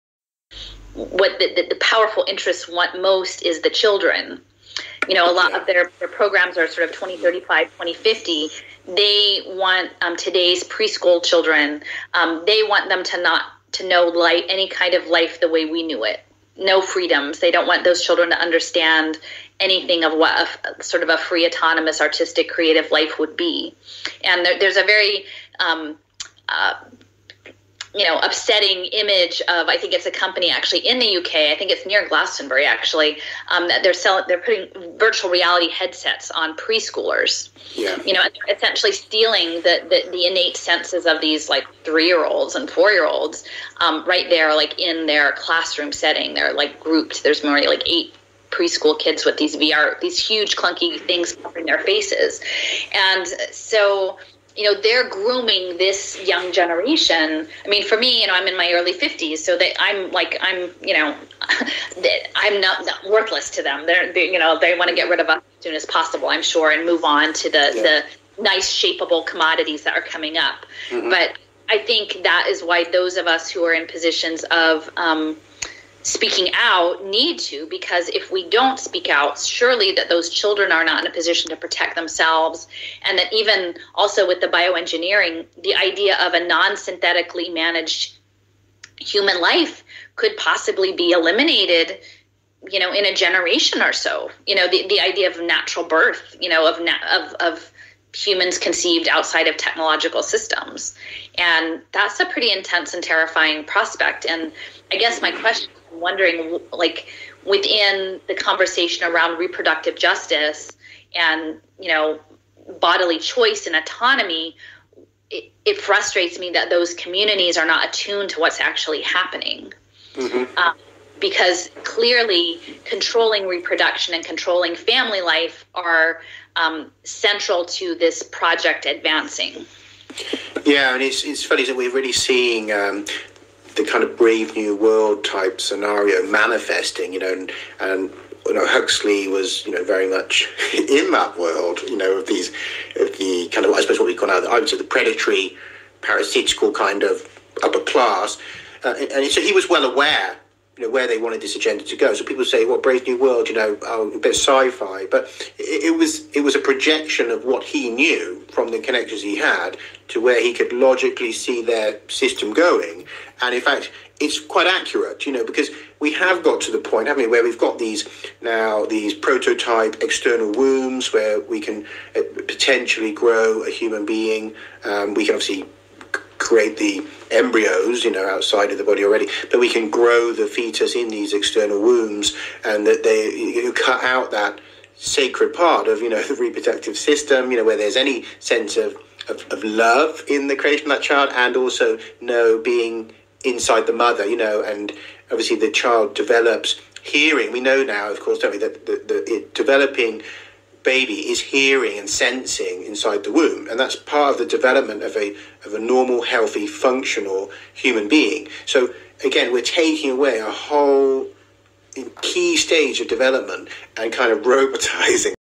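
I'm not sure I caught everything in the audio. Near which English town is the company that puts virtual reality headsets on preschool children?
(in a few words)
Glastonbury.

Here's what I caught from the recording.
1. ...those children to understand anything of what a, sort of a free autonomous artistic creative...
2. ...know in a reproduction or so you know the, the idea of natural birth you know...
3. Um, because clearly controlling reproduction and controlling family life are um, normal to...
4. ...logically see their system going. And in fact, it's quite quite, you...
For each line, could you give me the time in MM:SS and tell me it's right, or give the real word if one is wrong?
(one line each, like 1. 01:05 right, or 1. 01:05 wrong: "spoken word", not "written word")
1. 00:17 right
2. 01:32 wrong: "generation", not "reproduction"
3. 02:00 wrong: "central", not "normal"
4. 02:40 wrong: "accurate", not "quite".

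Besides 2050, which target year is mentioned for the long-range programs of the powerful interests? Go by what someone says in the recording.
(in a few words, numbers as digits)
2035.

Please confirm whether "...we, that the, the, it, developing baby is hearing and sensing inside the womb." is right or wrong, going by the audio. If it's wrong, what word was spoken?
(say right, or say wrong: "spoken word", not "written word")
right.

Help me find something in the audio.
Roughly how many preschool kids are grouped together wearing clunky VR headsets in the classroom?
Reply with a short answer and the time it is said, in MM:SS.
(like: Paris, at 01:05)
8, at 00:47.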